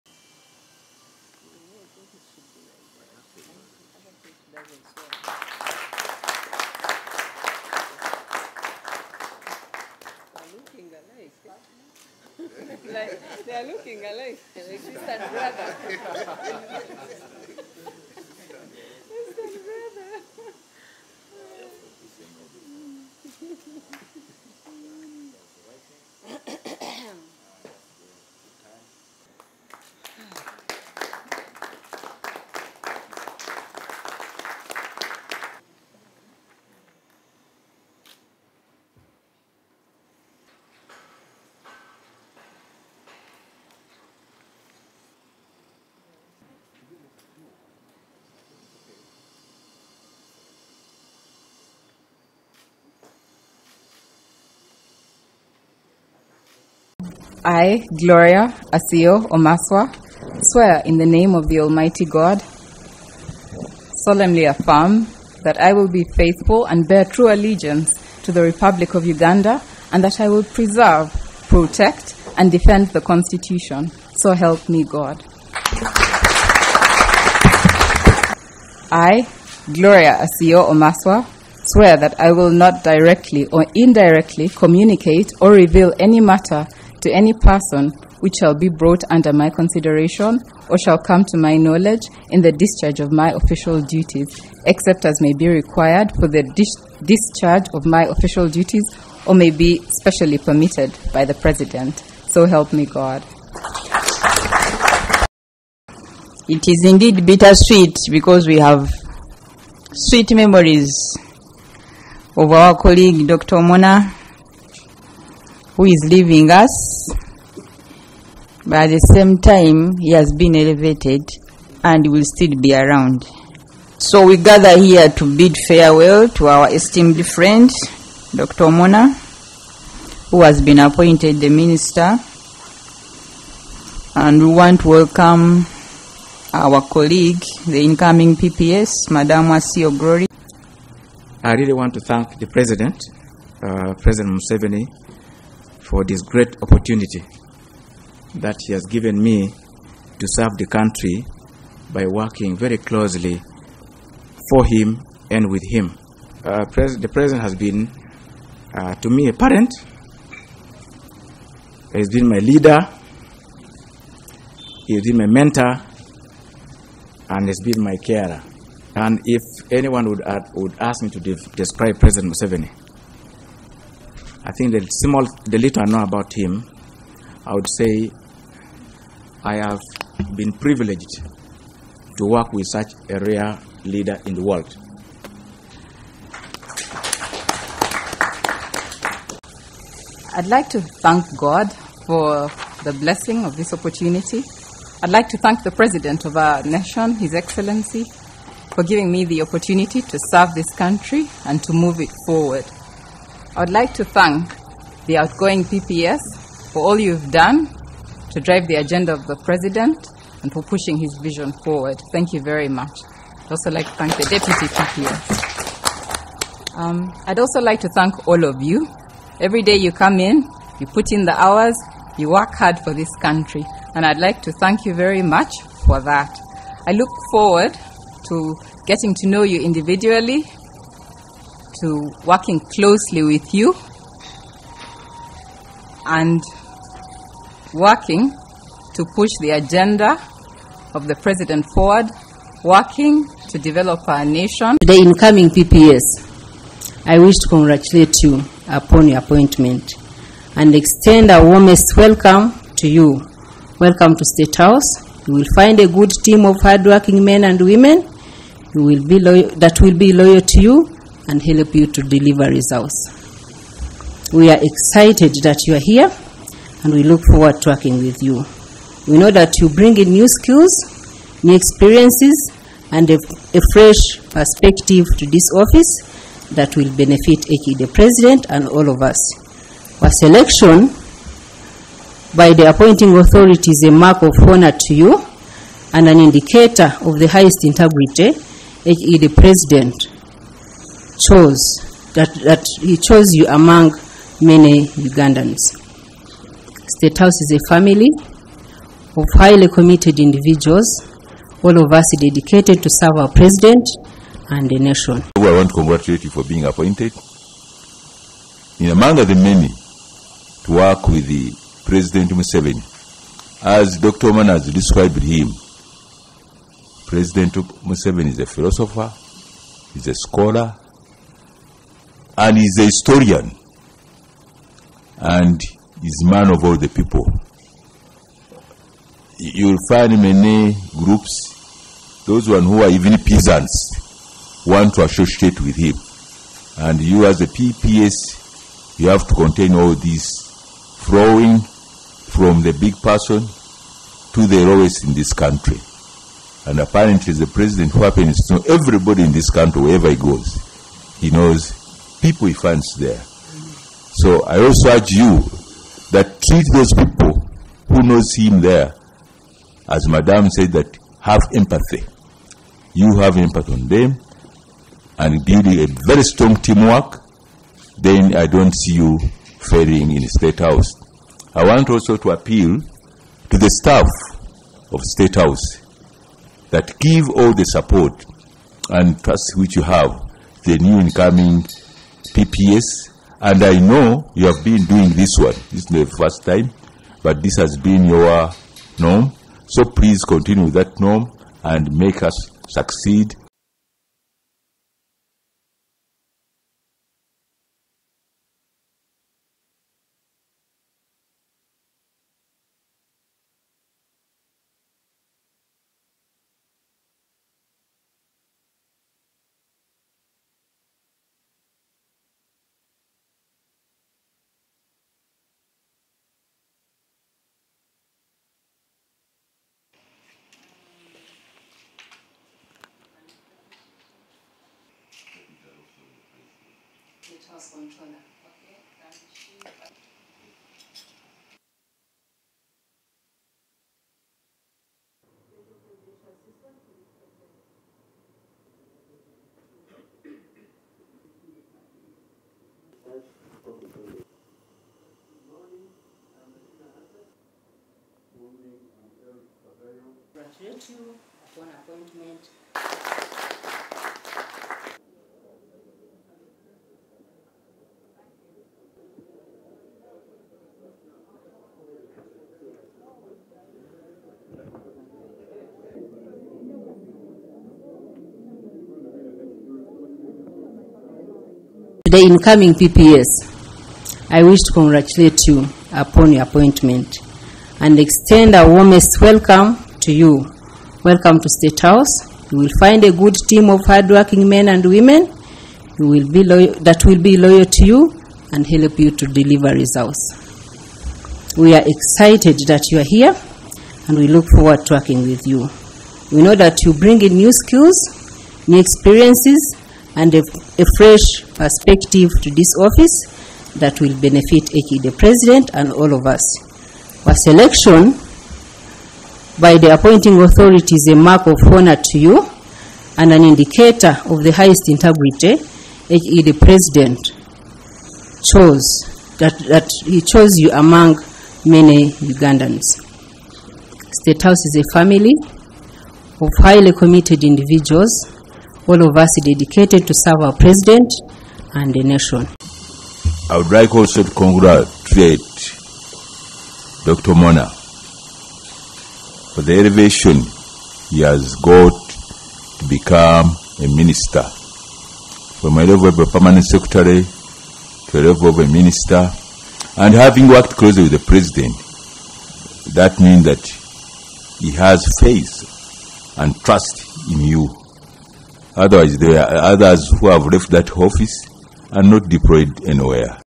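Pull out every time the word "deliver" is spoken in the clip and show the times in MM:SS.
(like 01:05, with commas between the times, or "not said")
04:22, 08:09.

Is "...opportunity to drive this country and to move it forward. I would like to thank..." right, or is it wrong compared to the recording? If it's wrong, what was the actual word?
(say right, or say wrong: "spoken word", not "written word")
wrong: "serve", not "drive".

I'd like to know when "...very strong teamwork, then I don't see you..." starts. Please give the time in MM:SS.
06:06.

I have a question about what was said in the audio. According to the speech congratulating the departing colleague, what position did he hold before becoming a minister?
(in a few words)
permanent secretary.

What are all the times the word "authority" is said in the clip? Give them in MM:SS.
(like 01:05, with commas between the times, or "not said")
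04:43, 08:30.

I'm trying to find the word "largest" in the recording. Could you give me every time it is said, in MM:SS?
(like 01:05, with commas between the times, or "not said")
not said.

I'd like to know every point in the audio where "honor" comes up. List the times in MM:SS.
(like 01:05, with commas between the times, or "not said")
04:44, 08:31.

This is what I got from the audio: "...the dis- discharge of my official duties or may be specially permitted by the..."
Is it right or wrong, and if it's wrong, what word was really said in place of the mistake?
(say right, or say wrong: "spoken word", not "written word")
right.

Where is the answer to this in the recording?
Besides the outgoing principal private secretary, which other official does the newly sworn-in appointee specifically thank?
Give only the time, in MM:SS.
03:34.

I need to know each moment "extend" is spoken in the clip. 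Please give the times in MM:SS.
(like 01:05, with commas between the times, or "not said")
04:10, 07:57.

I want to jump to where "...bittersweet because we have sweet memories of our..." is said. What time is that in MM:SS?
01:47.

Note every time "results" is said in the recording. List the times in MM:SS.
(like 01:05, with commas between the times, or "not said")
04:22, 08:09.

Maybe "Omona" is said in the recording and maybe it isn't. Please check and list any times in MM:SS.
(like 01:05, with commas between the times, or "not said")
01:53, 02:08, 05:14, 08:57.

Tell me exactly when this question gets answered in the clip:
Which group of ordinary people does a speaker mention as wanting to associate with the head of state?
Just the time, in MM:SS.
05:33.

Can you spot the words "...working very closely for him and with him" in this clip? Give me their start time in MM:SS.
02:32.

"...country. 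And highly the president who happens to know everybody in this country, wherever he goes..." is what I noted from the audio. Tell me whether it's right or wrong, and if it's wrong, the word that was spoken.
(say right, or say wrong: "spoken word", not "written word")
wrong: "apparently", not "highly".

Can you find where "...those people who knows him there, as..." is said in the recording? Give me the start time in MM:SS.
05:56.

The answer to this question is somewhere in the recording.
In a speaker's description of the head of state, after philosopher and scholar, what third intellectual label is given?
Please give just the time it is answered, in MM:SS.
05:22.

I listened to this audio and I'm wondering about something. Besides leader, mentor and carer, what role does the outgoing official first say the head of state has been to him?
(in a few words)
a parent.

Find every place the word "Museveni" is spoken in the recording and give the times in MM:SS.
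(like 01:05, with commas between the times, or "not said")
02:24, 02:52, 05:12, 05:17.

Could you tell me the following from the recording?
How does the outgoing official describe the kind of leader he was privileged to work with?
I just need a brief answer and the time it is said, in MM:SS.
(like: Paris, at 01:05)
a rare leader, at 03:03.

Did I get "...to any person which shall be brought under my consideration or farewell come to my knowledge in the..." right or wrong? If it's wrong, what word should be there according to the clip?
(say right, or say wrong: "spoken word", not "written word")
wrong: "shall", not "farewell".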